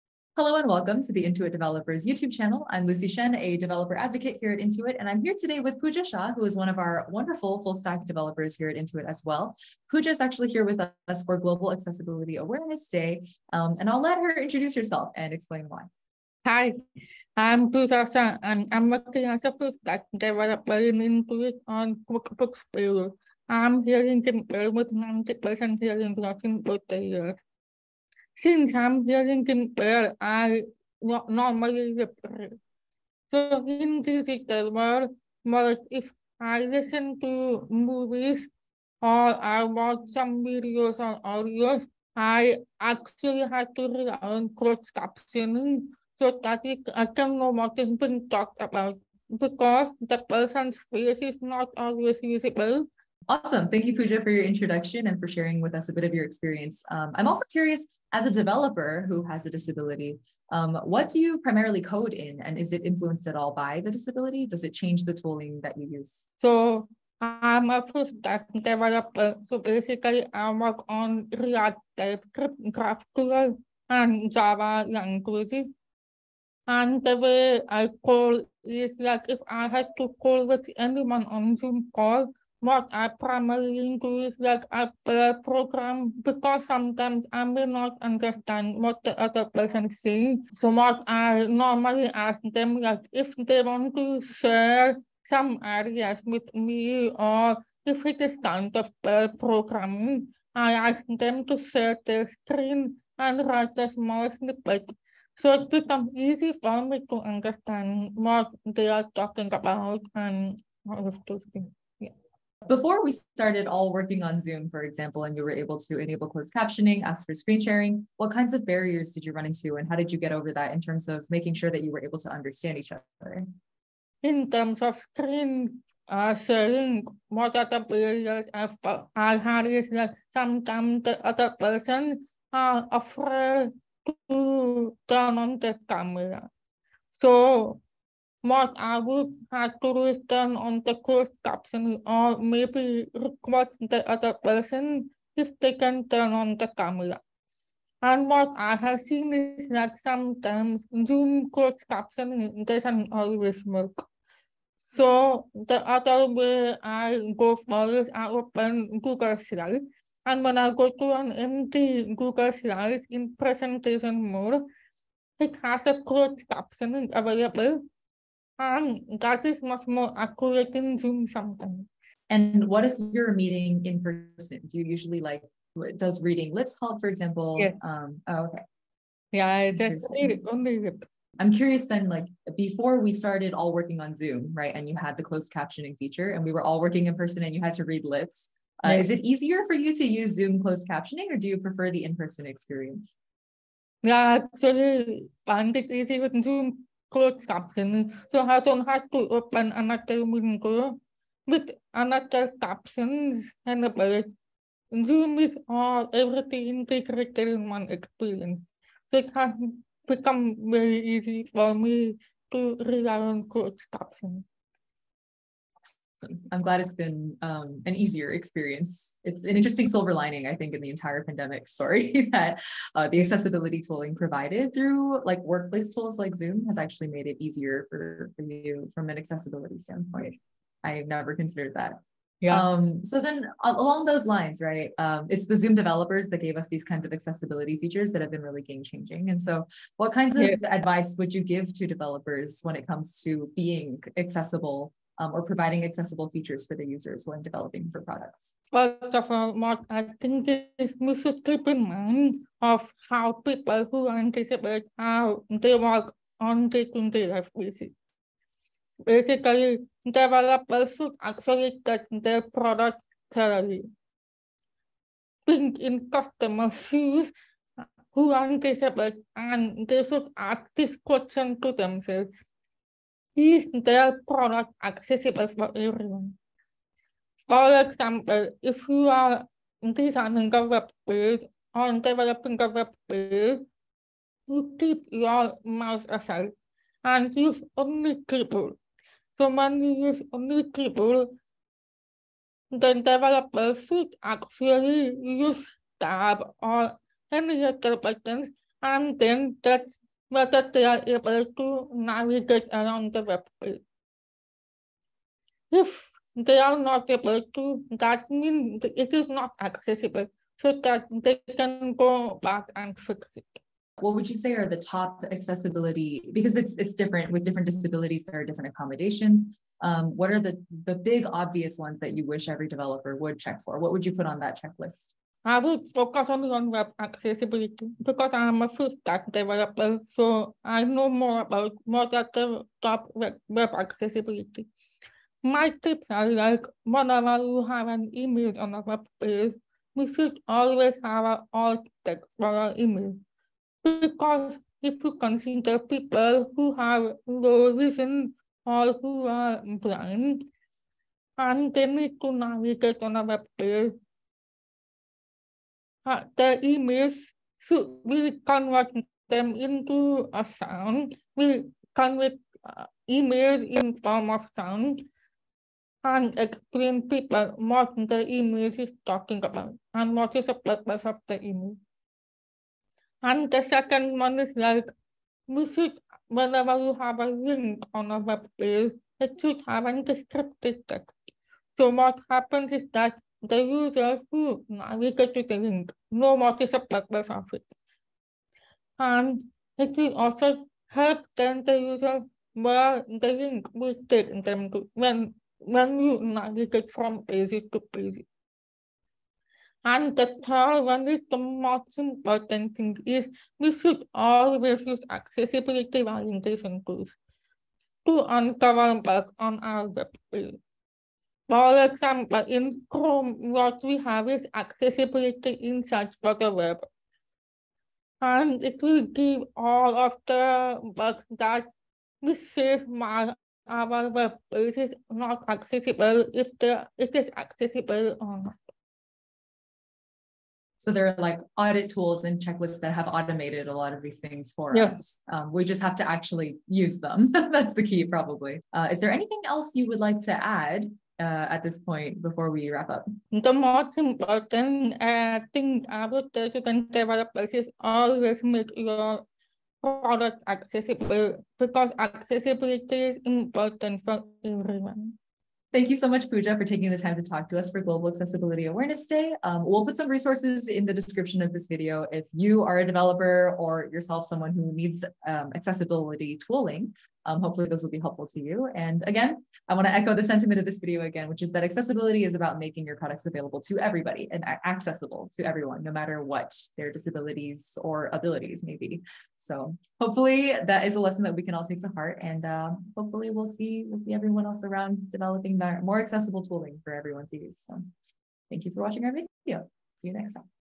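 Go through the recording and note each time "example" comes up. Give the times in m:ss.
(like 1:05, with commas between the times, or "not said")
1:54, 2:57, 4:37, 6:51.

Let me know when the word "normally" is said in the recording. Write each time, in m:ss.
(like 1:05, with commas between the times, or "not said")
0:31, 1:31.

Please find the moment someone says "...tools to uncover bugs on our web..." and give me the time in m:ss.
6:46.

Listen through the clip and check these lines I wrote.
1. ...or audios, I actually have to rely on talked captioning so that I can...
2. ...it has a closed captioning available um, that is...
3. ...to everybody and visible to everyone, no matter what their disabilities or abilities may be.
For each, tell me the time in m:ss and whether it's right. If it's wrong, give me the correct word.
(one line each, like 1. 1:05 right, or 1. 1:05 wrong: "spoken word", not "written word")
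1. 0:40 wrong: "closed", not "talked"
2. 2:45 right
3. 7:53 wrong: "accessible", not "visible".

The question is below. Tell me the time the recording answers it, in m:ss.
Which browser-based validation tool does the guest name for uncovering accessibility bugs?
6:54.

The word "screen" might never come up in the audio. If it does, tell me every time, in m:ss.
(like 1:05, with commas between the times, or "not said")
1:42, 1:57, 2:04.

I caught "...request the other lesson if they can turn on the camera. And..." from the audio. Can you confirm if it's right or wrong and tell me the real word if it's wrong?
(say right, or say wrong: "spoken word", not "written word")
wrong: "person", not "lesson".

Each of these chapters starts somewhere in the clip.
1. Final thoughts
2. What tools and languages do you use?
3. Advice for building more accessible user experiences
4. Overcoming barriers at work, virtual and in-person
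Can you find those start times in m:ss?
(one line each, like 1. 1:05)
1. 7:23
2. 0:57
3. 4:00
4. 1:58.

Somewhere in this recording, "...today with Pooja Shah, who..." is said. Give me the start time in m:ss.
0:05.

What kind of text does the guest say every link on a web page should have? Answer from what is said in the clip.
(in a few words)
descriptive text.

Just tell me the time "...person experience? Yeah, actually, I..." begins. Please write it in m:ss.
3:12.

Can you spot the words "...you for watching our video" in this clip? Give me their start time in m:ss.
8:08.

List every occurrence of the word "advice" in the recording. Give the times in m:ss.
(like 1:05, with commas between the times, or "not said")
4:00.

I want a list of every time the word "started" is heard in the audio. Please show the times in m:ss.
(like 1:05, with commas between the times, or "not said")
1:53, 3:03.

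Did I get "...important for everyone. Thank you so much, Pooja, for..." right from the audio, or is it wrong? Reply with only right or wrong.
right.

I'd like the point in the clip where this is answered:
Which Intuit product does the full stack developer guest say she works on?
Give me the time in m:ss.
0:22.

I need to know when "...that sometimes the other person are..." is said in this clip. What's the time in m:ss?
2:09.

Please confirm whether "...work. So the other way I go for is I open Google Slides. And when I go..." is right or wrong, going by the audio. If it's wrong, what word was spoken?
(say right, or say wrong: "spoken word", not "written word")
right.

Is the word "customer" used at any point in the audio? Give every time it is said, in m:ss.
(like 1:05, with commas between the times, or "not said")
4:26.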